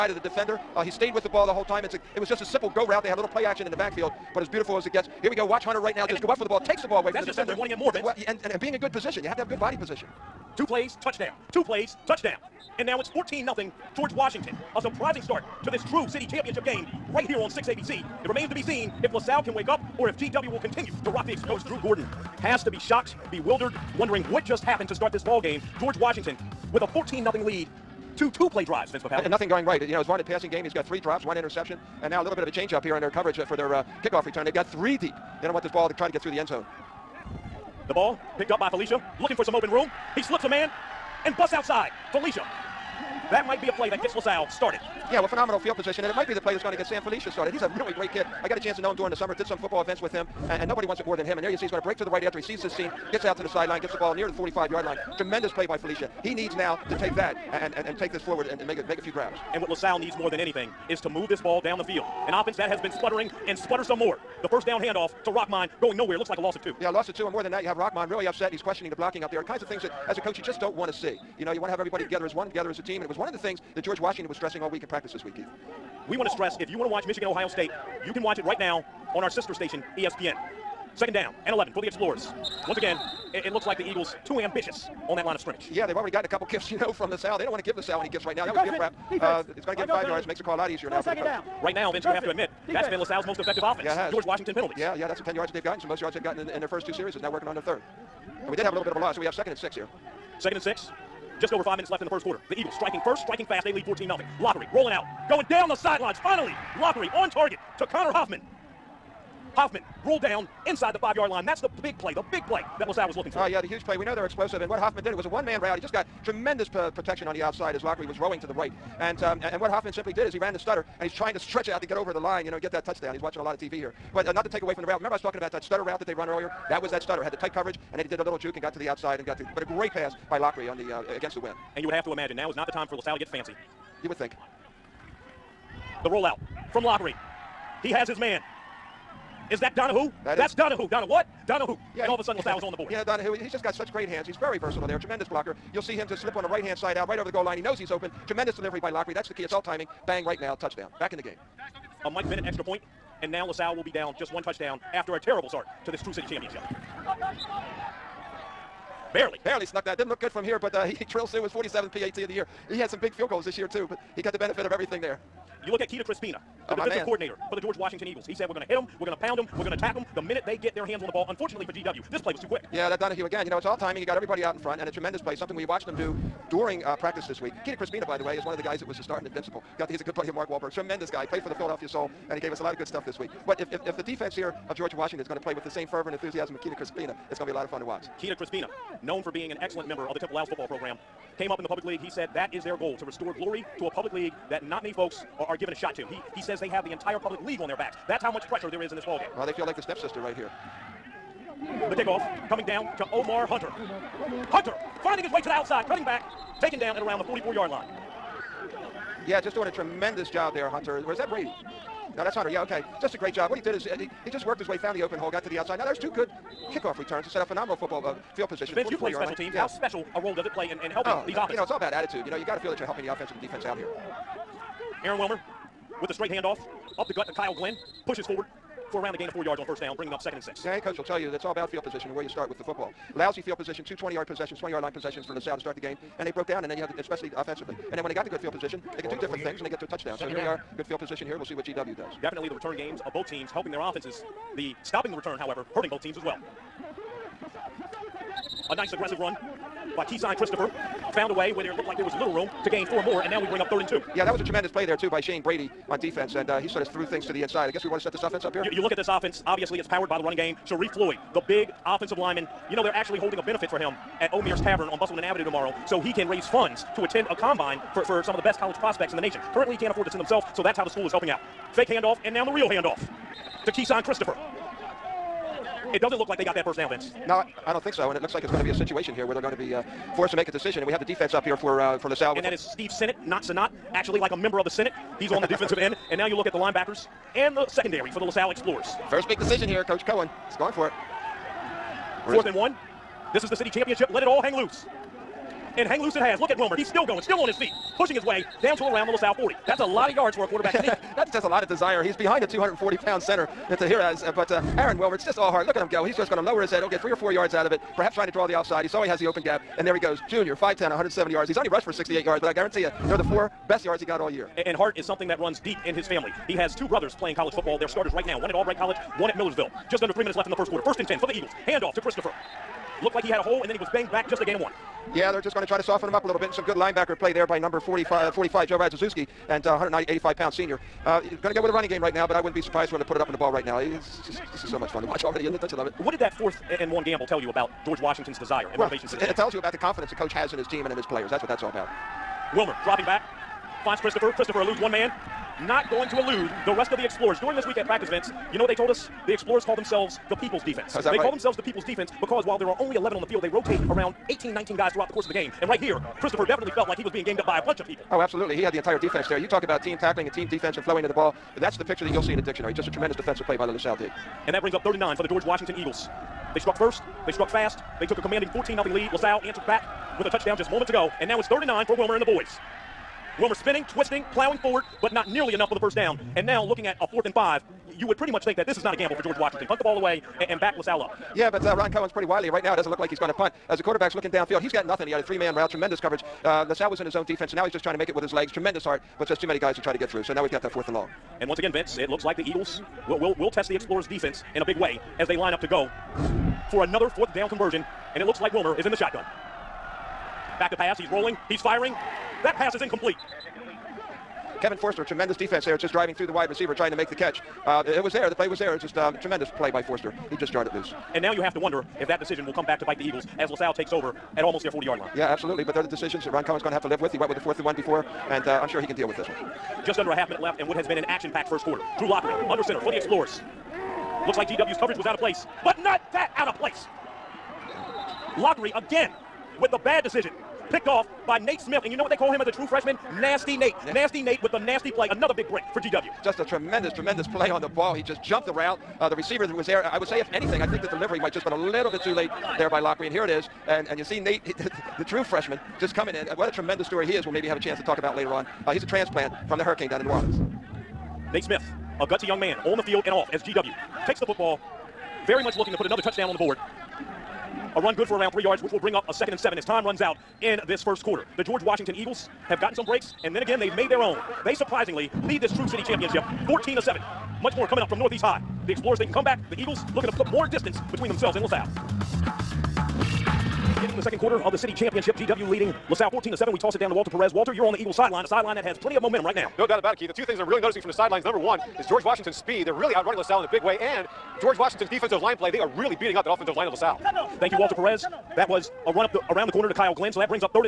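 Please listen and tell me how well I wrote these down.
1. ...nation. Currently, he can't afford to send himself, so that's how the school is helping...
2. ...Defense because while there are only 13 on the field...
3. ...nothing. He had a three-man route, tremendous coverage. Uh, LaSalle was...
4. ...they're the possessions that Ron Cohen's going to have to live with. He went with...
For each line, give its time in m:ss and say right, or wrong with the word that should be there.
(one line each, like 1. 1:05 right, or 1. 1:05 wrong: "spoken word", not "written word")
1. 4:29 right
2. 5:51 wrong: "11", not "13"
3. 6:24 right
4. 6:55 wrong: "decisions", not "possessions".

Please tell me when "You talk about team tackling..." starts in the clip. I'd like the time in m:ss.
5:59.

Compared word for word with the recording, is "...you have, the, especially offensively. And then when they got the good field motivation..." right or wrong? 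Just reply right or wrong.
wrong.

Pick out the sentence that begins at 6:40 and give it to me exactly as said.
Back to pass, he's rolling, he's firing.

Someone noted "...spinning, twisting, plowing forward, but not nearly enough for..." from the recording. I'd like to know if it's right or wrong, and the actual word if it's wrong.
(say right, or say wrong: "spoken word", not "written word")
right.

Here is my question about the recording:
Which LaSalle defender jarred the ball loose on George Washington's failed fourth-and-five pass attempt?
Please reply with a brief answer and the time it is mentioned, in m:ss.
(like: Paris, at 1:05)
Kevin Forster, at 6:44.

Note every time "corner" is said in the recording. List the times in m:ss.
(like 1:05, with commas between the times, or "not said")
8:09.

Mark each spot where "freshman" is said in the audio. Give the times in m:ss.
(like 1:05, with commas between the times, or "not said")
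7:12, 7:25.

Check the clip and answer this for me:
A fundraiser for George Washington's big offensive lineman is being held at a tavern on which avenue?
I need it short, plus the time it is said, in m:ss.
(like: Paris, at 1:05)
Bustleton Avenue, at 4:24.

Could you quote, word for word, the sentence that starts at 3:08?
Keita Crispina, known for being an excellent member of the Temple Owls football program, came up in the public league.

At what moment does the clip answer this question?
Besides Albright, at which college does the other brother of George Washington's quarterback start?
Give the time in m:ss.
5:19.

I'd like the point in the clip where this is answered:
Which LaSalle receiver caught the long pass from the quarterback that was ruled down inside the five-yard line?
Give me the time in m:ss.
1:47.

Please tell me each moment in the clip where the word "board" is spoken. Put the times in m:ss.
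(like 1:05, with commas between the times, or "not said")
2:22, 7:36.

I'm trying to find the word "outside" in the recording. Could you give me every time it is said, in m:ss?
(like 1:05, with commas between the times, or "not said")
0:41, 1:57, 2:08, 3:25, 3:35.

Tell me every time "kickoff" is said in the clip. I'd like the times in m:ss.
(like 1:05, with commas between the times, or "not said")
0:34, 3:21, 3:36.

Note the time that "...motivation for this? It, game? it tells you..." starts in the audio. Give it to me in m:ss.
5:38.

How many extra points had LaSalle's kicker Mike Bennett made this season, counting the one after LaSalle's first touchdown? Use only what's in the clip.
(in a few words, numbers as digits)
47.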